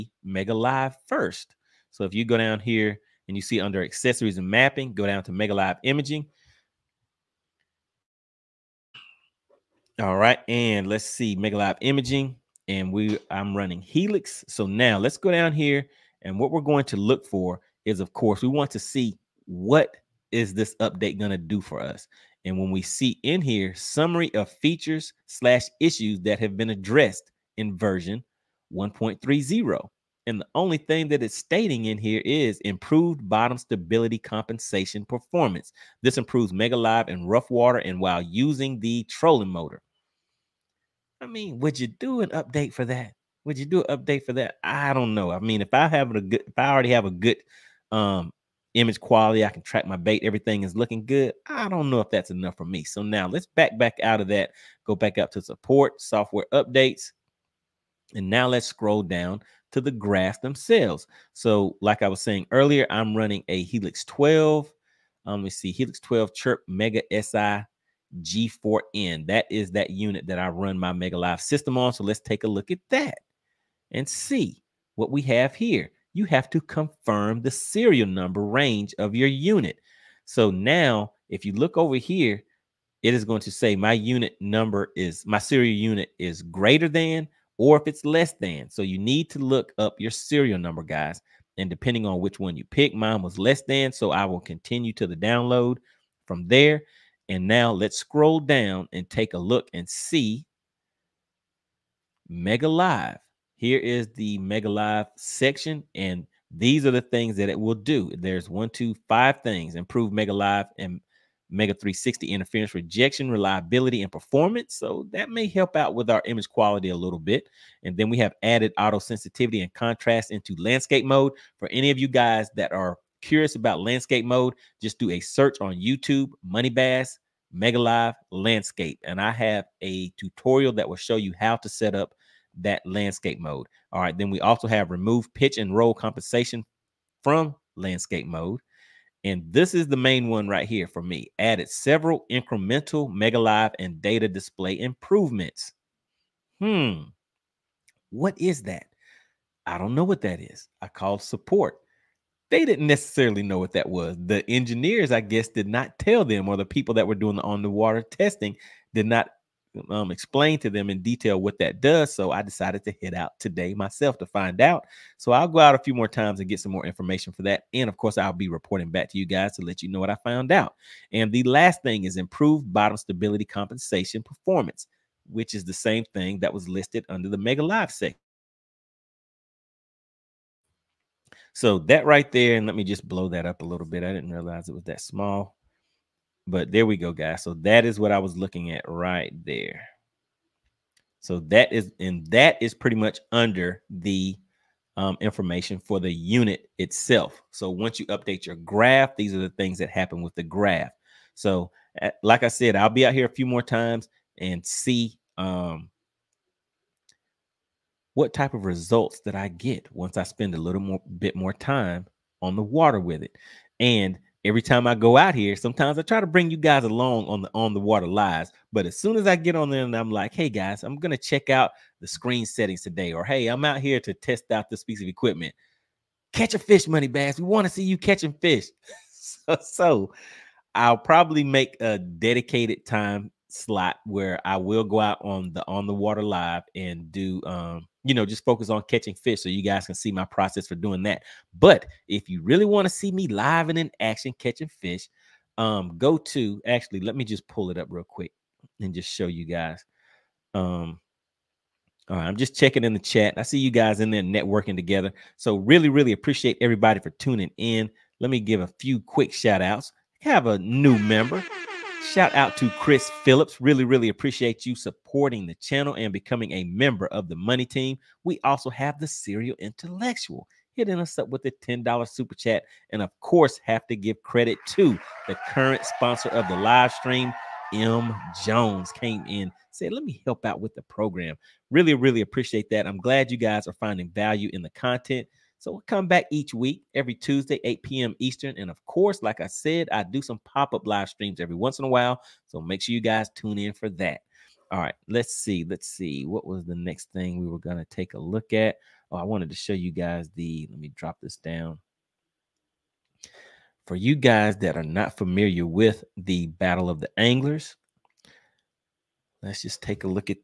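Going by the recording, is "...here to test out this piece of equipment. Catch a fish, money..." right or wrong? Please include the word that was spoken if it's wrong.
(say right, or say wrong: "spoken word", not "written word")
right.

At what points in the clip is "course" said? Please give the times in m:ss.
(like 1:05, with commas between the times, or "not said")
0:18, 2:47, 4:33, 4:48.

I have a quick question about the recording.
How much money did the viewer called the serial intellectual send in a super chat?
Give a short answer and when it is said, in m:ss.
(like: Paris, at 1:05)
$10, at 4:31.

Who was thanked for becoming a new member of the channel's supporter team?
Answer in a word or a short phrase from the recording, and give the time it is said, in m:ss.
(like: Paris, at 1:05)
Chris Phillips, at 4:22.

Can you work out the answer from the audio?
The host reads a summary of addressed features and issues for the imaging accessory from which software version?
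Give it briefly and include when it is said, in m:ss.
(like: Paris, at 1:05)
1.30, at 0:27.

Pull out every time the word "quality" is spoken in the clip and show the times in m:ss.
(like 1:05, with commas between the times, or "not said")
0:48, 1:56.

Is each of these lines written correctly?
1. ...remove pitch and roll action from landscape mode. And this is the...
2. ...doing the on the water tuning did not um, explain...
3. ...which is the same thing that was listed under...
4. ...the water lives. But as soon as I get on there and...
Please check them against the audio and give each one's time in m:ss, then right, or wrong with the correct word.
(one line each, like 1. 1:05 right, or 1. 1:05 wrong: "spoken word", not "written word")
1. 2:14 wrong: "compensation", not "action"
2. 2:37 wrong: "testing", not "tuning"
3. 2:55 right
4. 3:37 right.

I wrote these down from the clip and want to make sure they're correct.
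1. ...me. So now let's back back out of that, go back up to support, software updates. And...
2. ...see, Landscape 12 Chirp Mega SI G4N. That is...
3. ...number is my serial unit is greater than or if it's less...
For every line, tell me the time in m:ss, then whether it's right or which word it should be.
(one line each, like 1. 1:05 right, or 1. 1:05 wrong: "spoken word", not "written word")
1. 0:52 right
2. 1:05 wrong: "Helix", not "Landscape"
3. 1:24 right.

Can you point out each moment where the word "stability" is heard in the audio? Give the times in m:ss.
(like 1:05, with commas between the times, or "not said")
0:33, 2:52.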